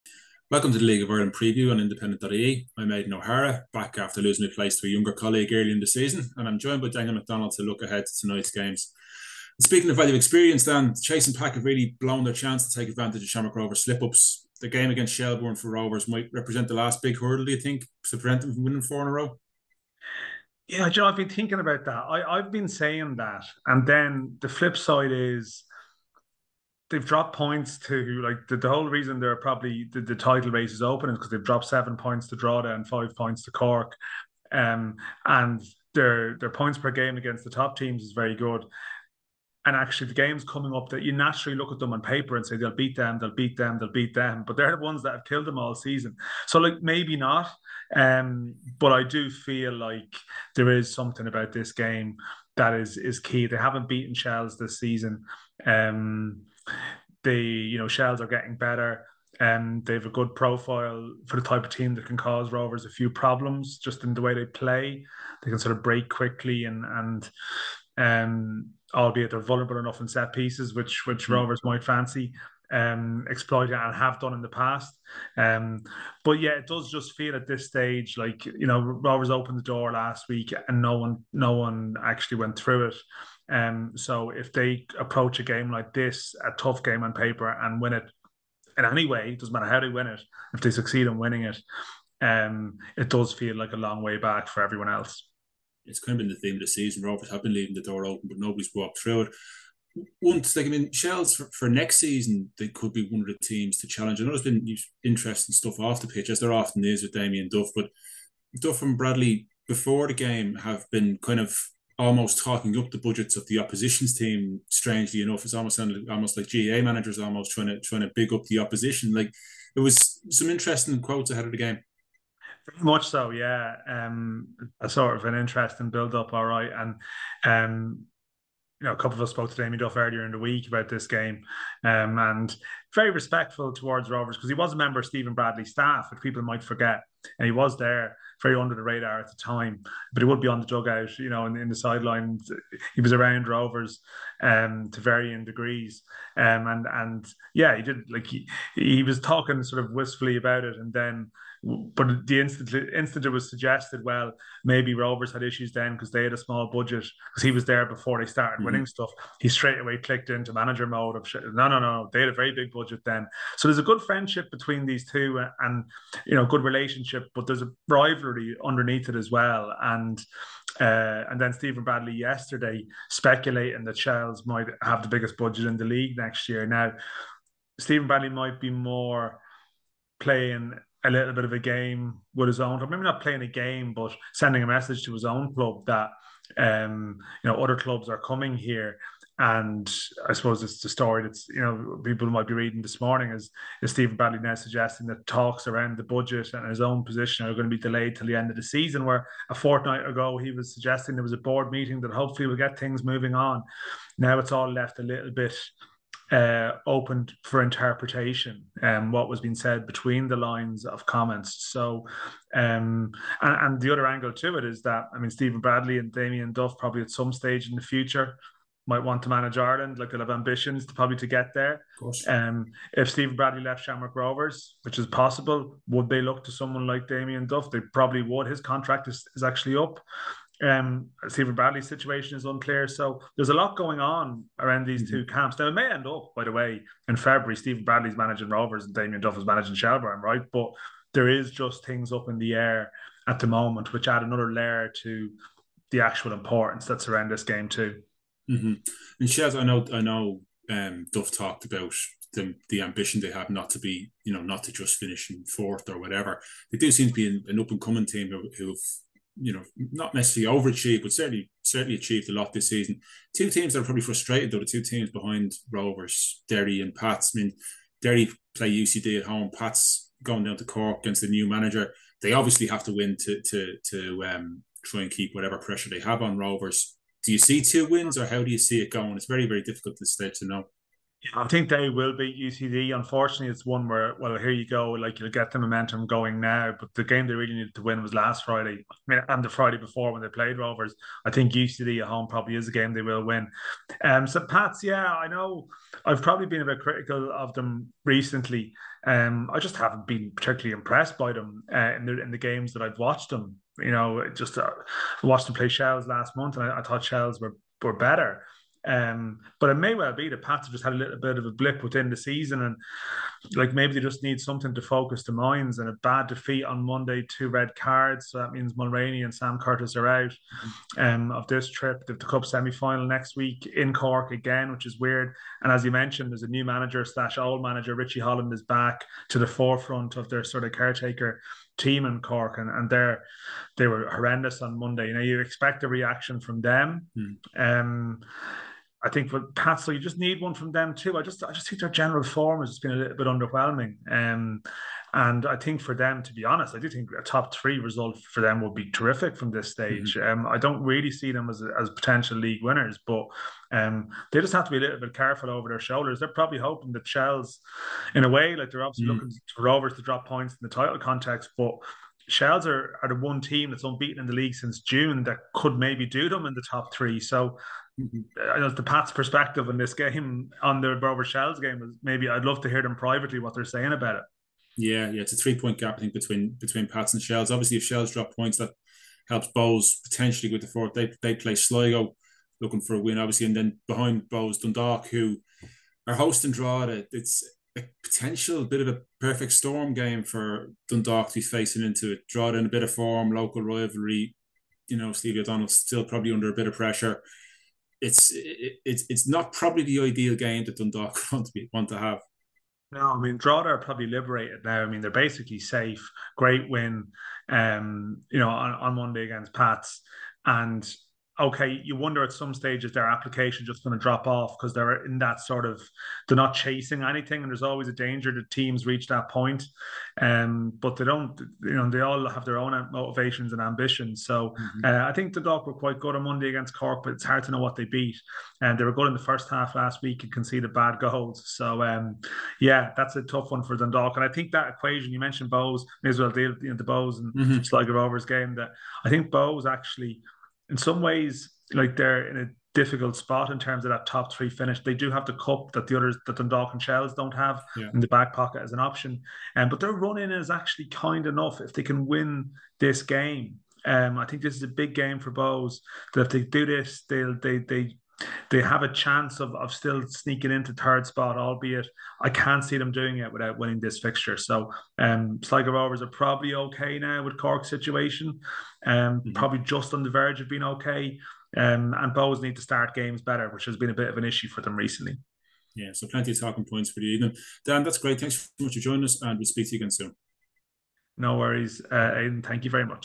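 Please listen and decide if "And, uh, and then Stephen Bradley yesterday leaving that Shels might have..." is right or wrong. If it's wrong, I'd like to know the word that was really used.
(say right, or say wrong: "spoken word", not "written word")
wrong: "speculating", not "leaving".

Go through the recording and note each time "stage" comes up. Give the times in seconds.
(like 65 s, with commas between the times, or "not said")
77 s, 217 s, 280 s, 350 s, 412 s.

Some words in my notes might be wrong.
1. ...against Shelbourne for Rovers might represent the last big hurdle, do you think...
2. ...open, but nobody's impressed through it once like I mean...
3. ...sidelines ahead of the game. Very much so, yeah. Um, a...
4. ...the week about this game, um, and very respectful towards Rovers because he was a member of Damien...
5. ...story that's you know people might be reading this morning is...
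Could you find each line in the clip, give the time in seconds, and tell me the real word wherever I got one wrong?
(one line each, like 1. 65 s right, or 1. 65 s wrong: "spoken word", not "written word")
1. 14 s right
2. 98 s wrong: "walked", not "impressed"
3. 121 s wrong: "quotes", not "sidelines"
4. 130 s wrong: "Stephen", not "Damien"
5. 190 s right.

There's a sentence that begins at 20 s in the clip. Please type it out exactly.
Yeah, Joe, I've been thinking about that.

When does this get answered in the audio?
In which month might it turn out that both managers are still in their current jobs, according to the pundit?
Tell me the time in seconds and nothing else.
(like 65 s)
237 s.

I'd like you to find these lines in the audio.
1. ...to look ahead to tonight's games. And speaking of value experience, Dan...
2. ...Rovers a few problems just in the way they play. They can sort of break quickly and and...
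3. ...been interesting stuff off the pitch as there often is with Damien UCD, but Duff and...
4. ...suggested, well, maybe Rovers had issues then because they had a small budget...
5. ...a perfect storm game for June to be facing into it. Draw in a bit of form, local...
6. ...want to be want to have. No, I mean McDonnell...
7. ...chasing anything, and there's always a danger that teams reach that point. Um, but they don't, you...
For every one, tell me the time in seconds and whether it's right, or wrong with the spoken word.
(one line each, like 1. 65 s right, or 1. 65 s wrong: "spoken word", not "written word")
1. 7 s right
2. 62 s right
3. 104 s wrong: "Duff", not "UCD"
4. 153 s right
5. 388 s wrong: "Dundalk", not "June"
6. 401 s wrong: "Drogheda", not "McDonnell"
7. 416 s right.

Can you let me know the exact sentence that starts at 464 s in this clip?
So um, Sligo Rovers are probably okay now with Cork situation, um, mm-hmm.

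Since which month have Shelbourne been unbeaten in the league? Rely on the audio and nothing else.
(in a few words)
June.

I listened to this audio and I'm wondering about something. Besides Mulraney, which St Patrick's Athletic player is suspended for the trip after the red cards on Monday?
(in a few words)
Sam Curtis.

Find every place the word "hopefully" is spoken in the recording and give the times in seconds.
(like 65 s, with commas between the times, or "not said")
202 s.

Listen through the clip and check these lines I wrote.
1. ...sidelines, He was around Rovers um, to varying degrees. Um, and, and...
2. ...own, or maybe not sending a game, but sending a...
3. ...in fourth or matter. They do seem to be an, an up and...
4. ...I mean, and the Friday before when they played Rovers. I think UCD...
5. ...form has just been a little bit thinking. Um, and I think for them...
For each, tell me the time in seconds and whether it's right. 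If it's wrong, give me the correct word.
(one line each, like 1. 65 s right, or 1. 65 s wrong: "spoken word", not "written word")
1. 141 s right
2. 182 s wrong: "playing", not "sending"
3. 255 s wrong: "whatever", not "matter"
4. 288 s right
5. 342 s wrong: "underwhelming", not "thinking".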